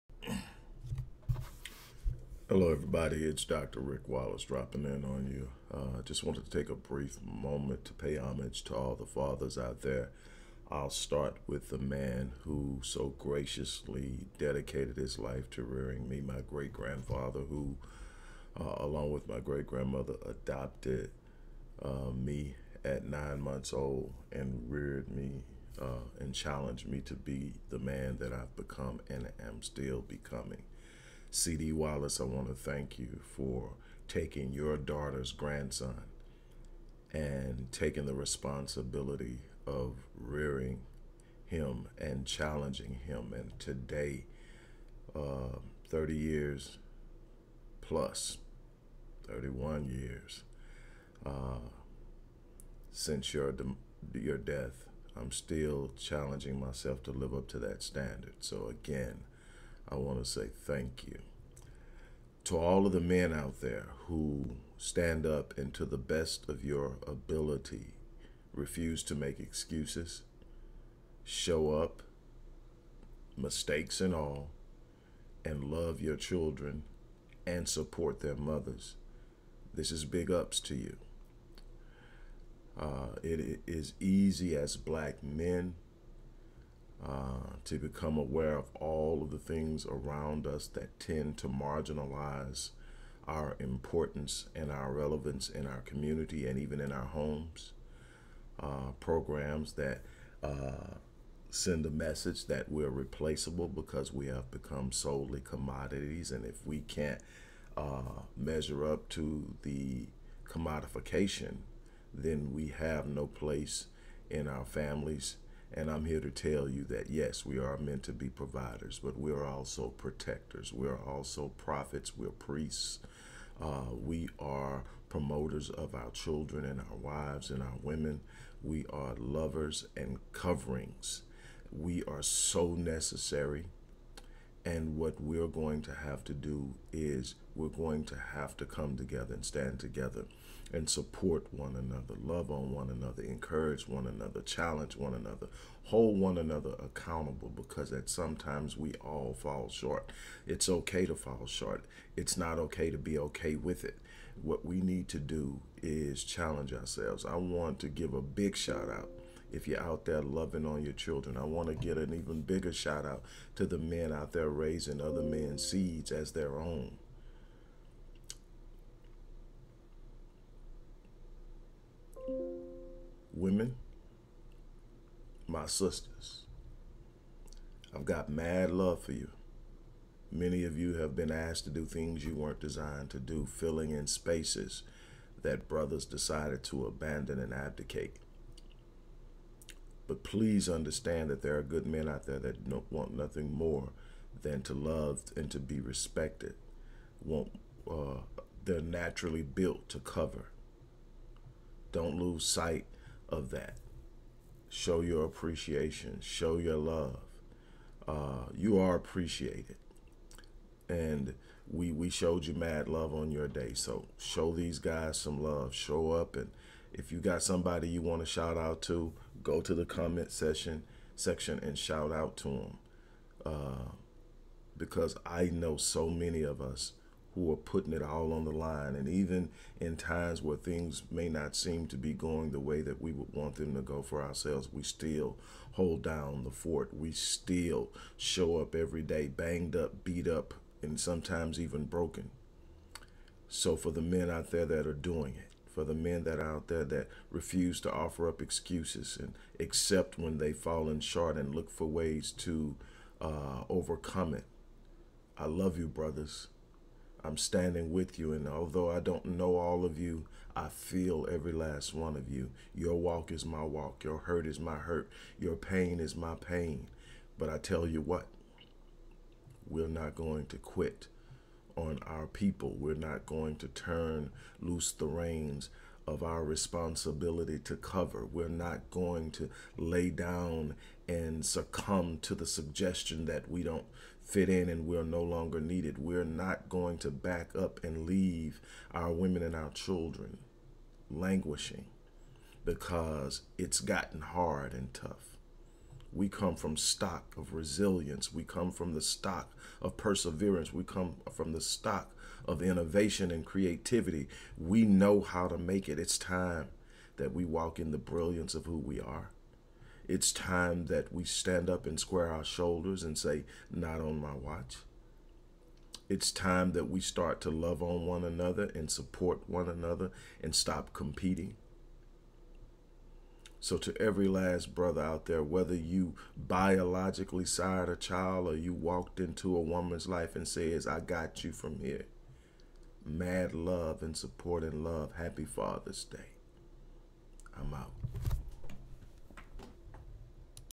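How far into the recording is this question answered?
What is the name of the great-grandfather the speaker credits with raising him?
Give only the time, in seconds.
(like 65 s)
31 s.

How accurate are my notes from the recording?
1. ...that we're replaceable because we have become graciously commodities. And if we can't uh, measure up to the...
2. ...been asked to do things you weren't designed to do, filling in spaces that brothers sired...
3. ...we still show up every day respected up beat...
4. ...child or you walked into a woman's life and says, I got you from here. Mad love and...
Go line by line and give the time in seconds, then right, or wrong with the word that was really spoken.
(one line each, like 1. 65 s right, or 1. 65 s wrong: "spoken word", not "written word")
1. 102 s wrong: "solely", not "graciously"
2. 181 s wrong: "decided", not "sired"
3. 236 s wrong: "banged", not "respected"
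4. 327 s right.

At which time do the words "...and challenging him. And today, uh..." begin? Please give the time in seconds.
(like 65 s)
41 s.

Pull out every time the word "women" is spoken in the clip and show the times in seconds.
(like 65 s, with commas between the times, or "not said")
127 s, 173 s, 289 s.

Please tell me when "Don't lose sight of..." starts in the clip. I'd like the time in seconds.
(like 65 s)
201 s.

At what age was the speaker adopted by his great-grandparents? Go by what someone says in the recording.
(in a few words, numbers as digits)
9 months old.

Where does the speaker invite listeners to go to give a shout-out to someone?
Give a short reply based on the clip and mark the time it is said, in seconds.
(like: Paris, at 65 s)
the comment section, at 219 s.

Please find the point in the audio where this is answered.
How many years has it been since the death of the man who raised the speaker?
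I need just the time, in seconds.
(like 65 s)
49 s.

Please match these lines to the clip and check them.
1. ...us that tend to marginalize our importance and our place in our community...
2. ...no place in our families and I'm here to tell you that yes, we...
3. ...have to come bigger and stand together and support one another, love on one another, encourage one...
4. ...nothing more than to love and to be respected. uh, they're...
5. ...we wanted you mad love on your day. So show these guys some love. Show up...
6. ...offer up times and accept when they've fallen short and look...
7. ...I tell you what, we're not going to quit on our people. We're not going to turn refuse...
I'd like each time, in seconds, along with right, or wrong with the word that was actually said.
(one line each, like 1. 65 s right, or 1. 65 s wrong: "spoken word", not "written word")
1. 90 s wrong: "relevance", not "place"
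2. 113 s right
3. 138 s wrong: "together", not "bigger"
4. 193 s right
5. 211 s wrong: "showed", not "wanted"
6. 247 s wrong: "excuses", not "times"
7. 267 s wrong: "loose", not "refuse".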